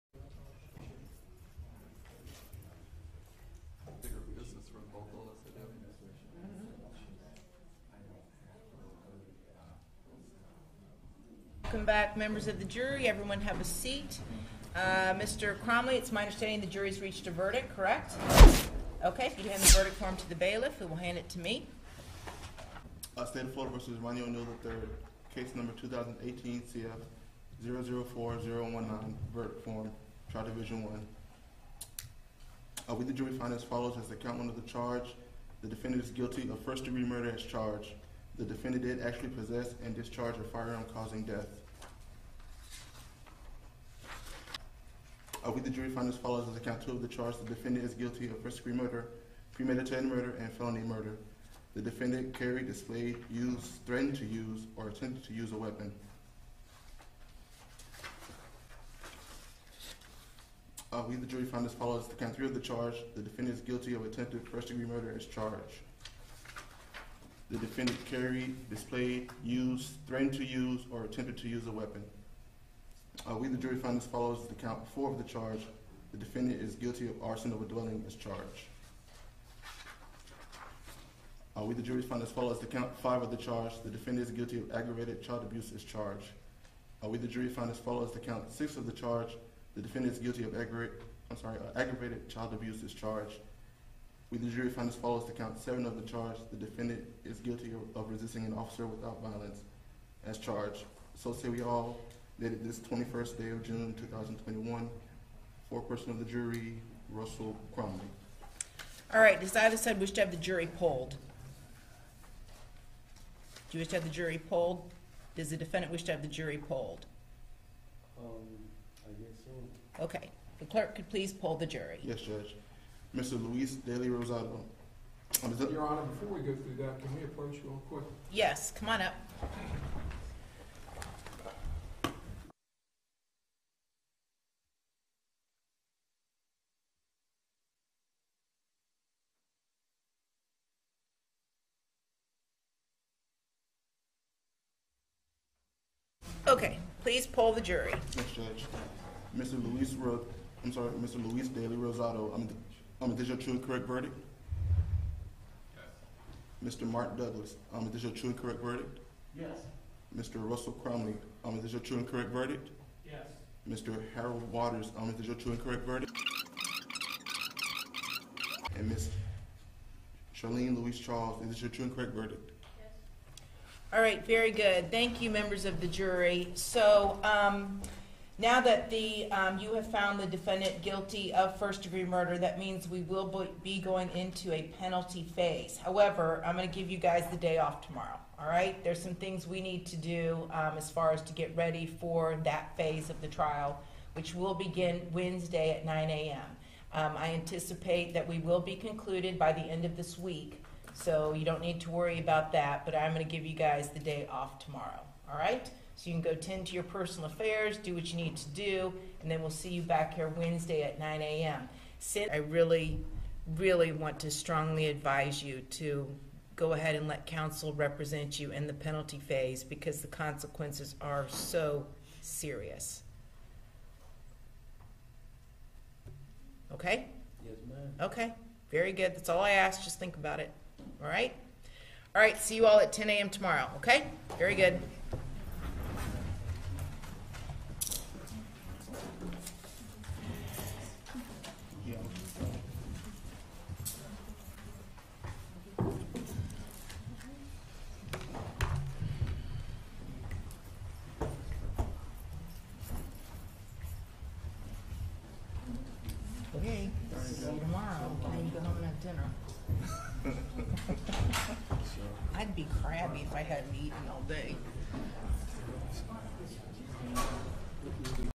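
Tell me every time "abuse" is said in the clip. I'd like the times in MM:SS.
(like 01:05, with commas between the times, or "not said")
01:25, 01:32.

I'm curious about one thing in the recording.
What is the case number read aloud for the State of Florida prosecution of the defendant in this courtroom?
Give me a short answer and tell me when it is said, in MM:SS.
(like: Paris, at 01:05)
2018 CF 004019, at 00:25.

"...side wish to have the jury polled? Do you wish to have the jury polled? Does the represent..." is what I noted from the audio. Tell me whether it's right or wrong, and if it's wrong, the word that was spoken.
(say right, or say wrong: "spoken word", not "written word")
wrong: "defendant", not "represent".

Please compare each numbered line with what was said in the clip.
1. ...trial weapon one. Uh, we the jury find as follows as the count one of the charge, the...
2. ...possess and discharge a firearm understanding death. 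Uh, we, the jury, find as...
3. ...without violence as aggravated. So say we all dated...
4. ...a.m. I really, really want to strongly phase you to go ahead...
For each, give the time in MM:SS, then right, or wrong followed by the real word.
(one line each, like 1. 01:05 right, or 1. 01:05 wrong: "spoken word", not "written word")
1. 00:30 wrong: "division", not "weapon"
2. 00:39 wrong: "causing", not "understanding"
3. 01:38 wrong: "charged", not "aggravated"
4. 03:31 wrong: "advise", not "phase".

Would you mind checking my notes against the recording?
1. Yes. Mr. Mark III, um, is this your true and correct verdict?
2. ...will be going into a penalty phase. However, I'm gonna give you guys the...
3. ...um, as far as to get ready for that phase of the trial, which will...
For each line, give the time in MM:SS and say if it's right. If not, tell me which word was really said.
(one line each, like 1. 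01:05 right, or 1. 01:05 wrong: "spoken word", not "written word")
1. 02:36 wrong: "Douglas", not "III"
2. 03:03 right
3. 03:10 right.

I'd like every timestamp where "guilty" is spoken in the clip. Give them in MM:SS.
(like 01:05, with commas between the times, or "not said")
00:36, 00:47, 01:03, 01:16, 01:24, 01:30, 01:37, 03:00.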